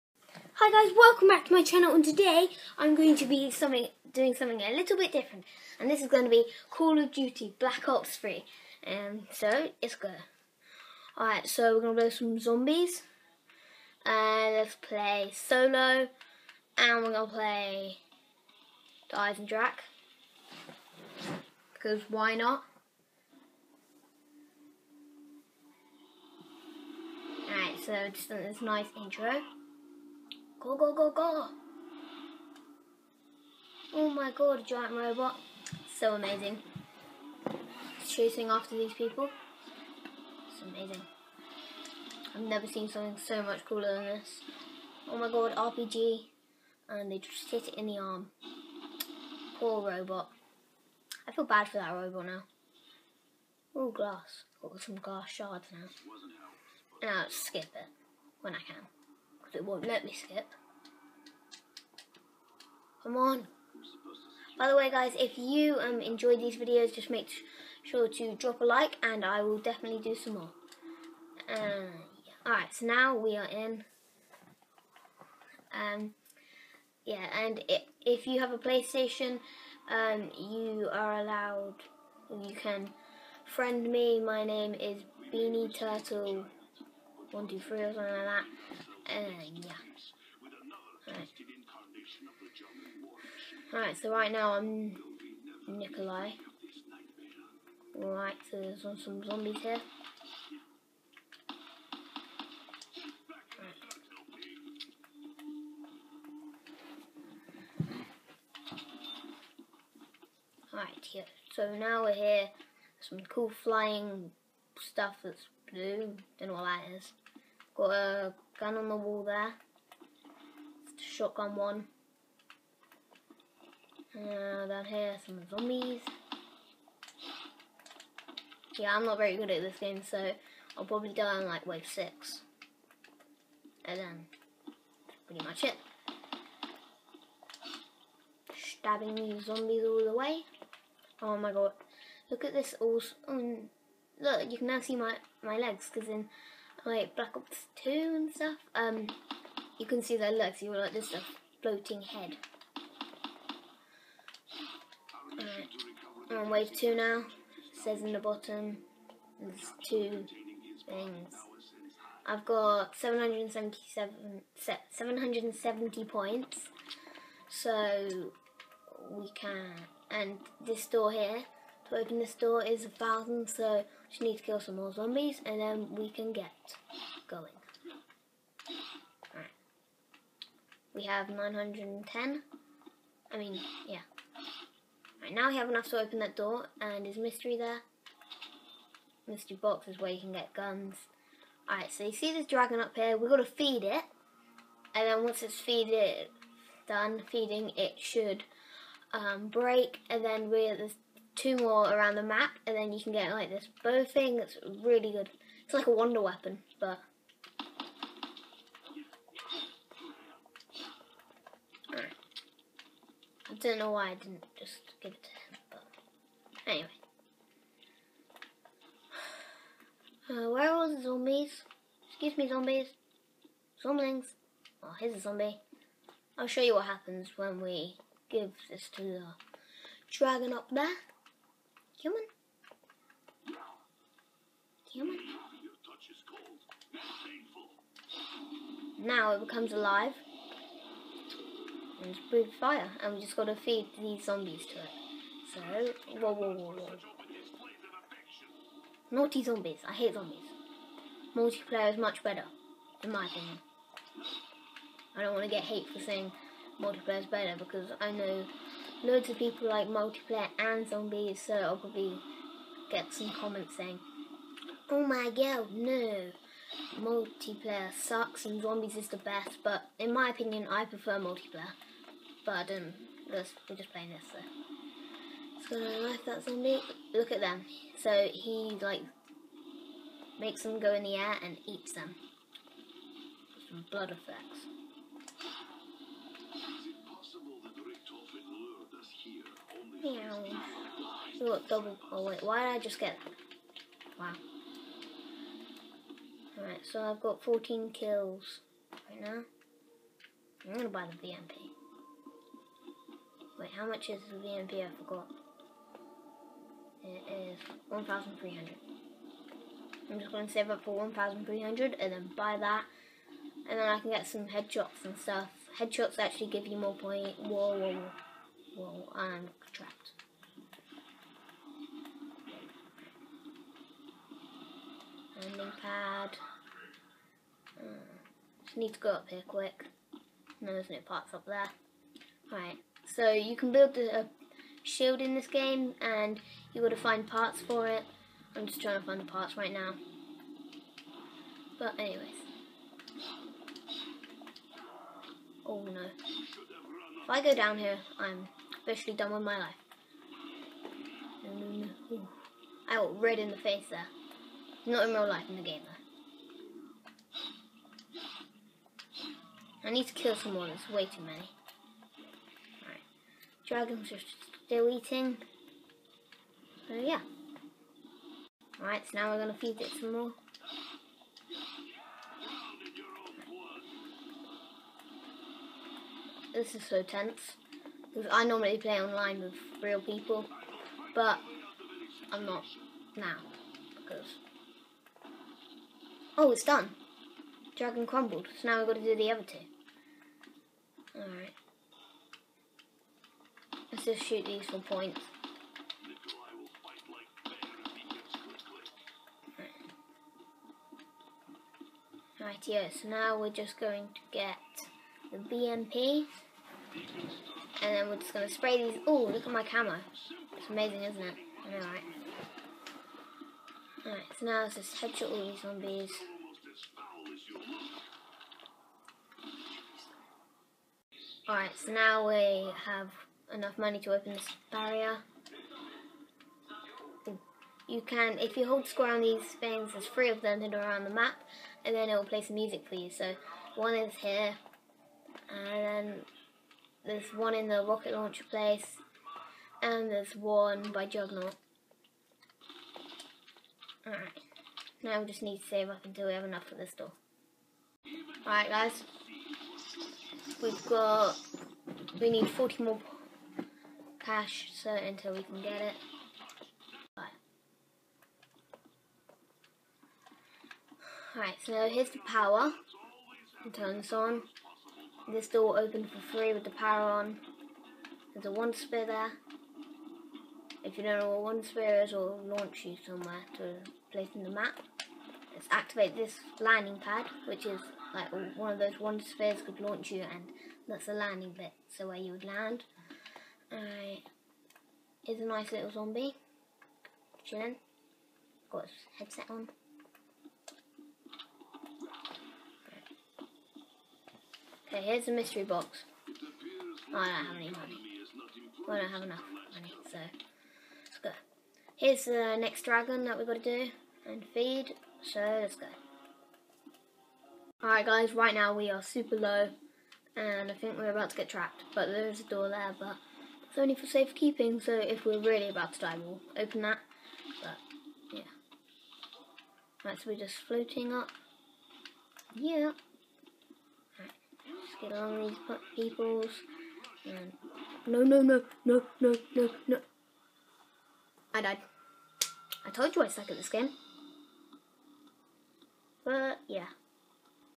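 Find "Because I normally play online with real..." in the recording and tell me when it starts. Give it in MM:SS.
06:18.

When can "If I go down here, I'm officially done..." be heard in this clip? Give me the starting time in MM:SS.
05:47.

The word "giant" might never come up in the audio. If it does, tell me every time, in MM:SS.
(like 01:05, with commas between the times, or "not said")
00:34.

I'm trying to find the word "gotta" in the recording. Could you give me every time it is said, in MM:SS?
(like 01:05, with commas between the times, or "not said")
04:03, 05:36.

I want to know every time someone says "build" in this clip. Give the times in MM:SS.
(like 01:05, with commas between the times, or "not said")
05:33.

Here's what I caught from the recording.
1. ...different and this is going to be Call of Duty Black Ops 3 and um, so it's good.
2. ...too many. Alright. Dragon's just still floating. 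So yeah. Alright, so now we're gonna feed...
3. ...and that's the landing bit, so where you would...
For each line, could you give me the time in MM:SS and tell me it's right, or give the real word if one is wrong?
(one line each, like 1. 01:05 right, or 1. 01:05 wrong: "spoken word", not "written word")
1. 00:05 right
2. 06:01 wrong: "eating", not "floating"
3. 08:00 right.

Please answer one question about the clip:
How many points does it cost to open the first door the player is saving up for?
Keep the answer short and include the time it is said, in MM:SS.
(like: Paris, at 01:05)
1,000, at 02:52.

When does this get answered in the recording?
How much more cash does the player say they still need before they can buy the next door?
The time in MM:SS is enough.
07:32.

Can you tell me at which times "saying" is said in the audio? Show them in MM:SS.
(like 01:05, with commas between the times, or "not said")
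04:15, 04:23.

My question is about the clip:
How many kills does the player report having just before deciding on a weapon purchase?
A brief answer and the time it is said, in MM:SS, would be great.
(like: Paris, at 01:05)
14, at 04:57.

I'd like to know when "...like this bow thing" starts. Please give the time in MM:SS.
03:23.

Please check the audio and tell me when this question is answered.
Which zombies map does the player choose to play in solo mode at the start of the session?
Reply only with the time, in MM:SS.
00:19.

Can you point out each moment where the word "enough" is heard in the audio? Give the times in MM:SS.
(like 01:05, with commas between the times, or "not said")
03:05, 07:03, 07:26, 08:19.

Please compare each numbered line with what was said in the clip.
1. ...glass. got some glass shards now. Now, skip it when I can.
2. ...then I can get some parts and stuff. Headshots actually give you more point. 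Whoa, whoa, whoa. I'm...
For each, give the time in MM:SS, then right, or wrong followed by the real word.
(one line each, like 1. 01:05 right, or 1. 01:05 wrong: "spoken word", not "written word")
1. 00:53 right
2. 05:13 wrong: "headshots", not "parts".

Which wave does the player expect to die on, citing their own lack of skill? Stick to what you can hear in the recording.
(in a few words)
wave 6.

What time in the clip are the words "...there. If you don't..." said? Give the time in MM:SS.
07:49.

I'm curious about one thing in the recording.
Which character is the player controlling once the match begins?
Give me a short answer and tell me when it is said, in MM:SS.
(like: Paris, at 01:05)
Nikolai, at 01:35.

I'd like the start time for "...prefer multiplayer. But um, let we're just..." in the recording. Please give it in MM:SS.
04:30.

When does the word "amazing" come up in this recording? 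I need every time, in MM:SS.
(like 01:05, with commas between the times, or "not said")
00:36, 00:40, 06:50.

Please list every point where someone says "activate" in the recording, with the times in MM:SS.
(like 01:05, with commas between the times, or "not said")
07:55.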